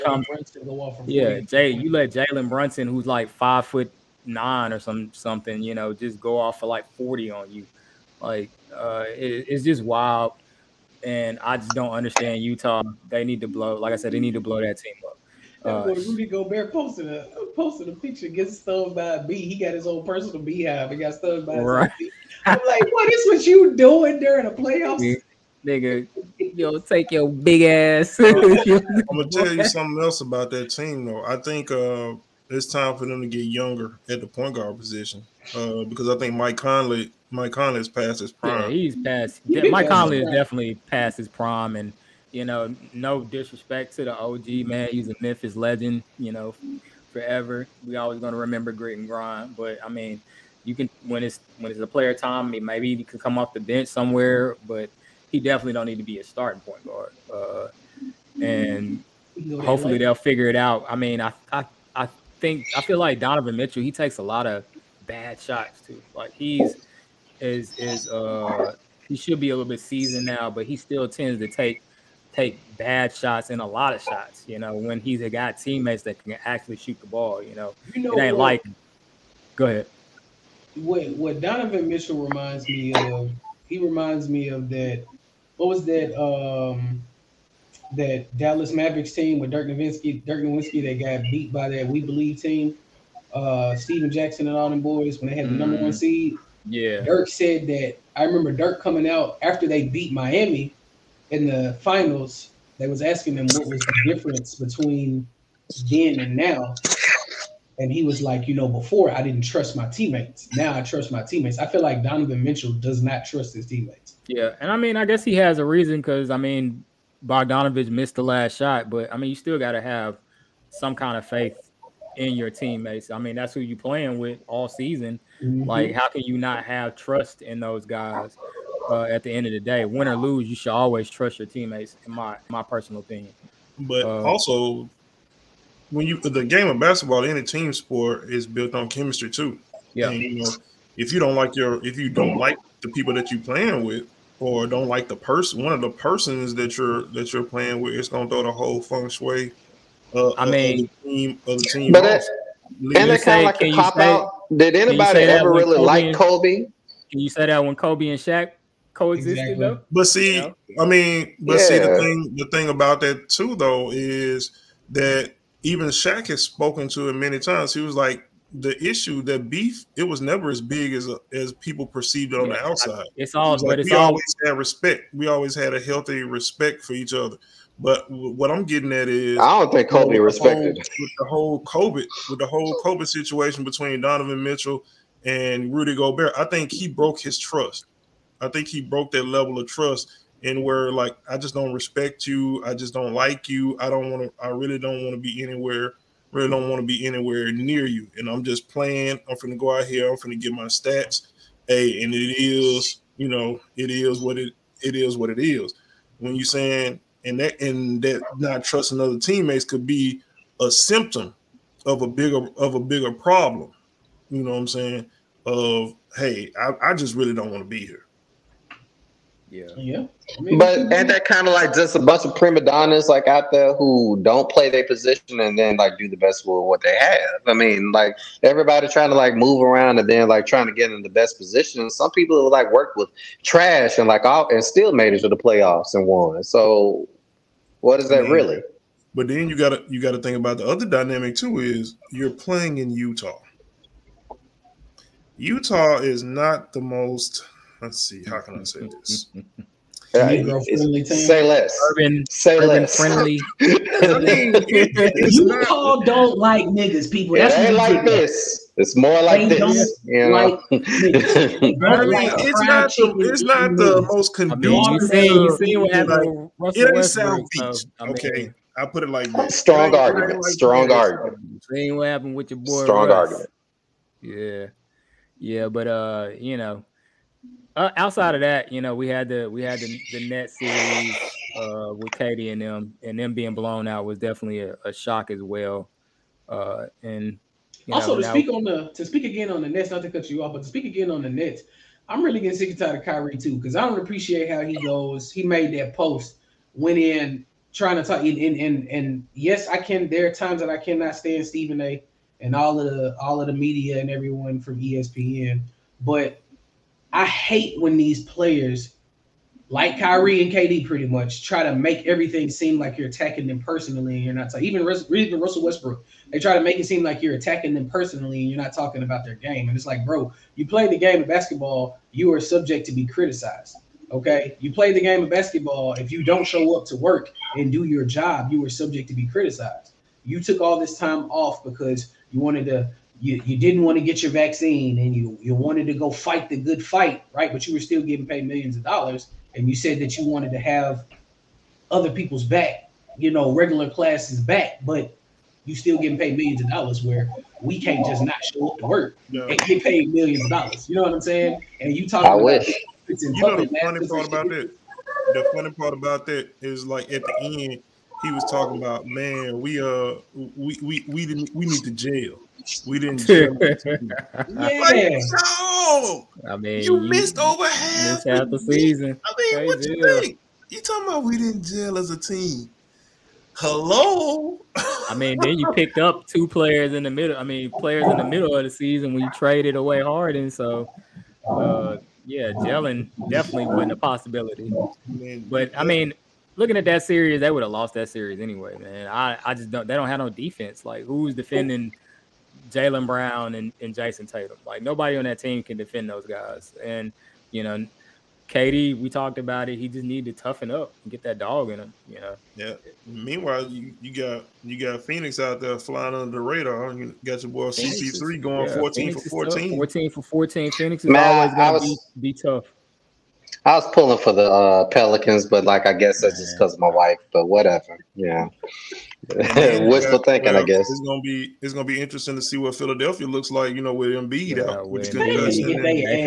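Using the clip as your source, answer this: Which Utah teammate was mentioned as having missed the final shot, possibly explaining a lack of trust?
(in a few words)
Bogdanovich.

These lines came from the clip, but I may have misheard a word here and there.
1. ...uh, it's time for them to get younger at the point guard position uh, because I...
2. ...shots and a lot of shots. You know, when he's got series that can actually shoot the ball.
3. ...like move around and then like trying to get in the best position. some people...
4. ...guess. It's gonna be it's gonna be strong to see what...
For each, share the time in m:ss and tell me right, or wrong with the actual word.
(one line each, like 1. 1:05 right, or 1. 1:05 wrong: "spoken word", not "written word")
1. 0:31 right
2. 1:13 wrong: "teammates", not "series"
3. 3:49 right
4. 7:00 wrong: "interesting", not "strong".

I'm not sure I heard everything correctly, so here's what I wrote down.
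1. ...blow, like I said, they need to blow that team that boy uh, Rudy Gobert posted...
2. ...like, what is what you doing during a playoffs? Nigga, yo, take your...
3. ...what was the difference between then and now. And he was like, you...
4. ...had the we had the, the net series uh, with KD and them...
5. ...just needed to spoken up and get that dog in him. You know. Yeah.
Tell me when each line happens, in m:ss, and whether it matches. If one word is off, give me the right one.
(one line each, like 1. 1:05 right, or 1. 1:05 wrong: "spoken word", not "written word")
1. 0:13 right
2. 0:22 right
3. 1:43 right
4. 4:39 right
5. 6:39 wrong: "toughen", not "spoken".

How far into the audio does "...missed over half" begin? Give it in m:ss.
6:07.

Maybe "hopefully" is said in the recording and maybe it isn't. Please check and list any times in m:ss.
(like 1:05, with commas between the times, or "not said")
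0:59.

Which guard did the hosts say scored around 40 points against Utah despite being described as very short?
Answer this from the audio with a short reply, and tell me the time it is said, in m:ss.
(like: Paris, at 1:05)
Jalen Brunson, at 0:02.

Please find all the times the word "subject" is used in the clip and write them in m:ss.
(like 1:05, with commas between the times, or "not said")
5:22, 5:28.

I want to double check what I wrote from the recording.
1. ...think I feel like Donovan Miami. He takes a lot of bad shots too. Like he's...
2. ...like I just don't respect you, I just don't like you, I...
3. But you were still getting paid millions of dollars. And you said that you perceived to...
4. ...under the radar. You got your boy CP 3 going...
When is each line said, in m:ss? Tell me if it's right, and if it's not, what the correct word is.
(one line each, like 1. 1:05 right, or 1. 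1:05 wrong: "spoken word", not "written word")
1. 1:02 wrong: "Mitchell", not "Miami"
2. 3:10 right
3. 5:37 wrong: "wanted", not "perceived"
4. 6:46 right.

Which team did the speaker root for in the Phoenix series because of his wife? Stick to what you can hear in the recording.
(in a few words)
Pelicans.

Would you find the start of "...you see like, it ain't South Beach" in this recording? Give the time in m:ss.
4:25.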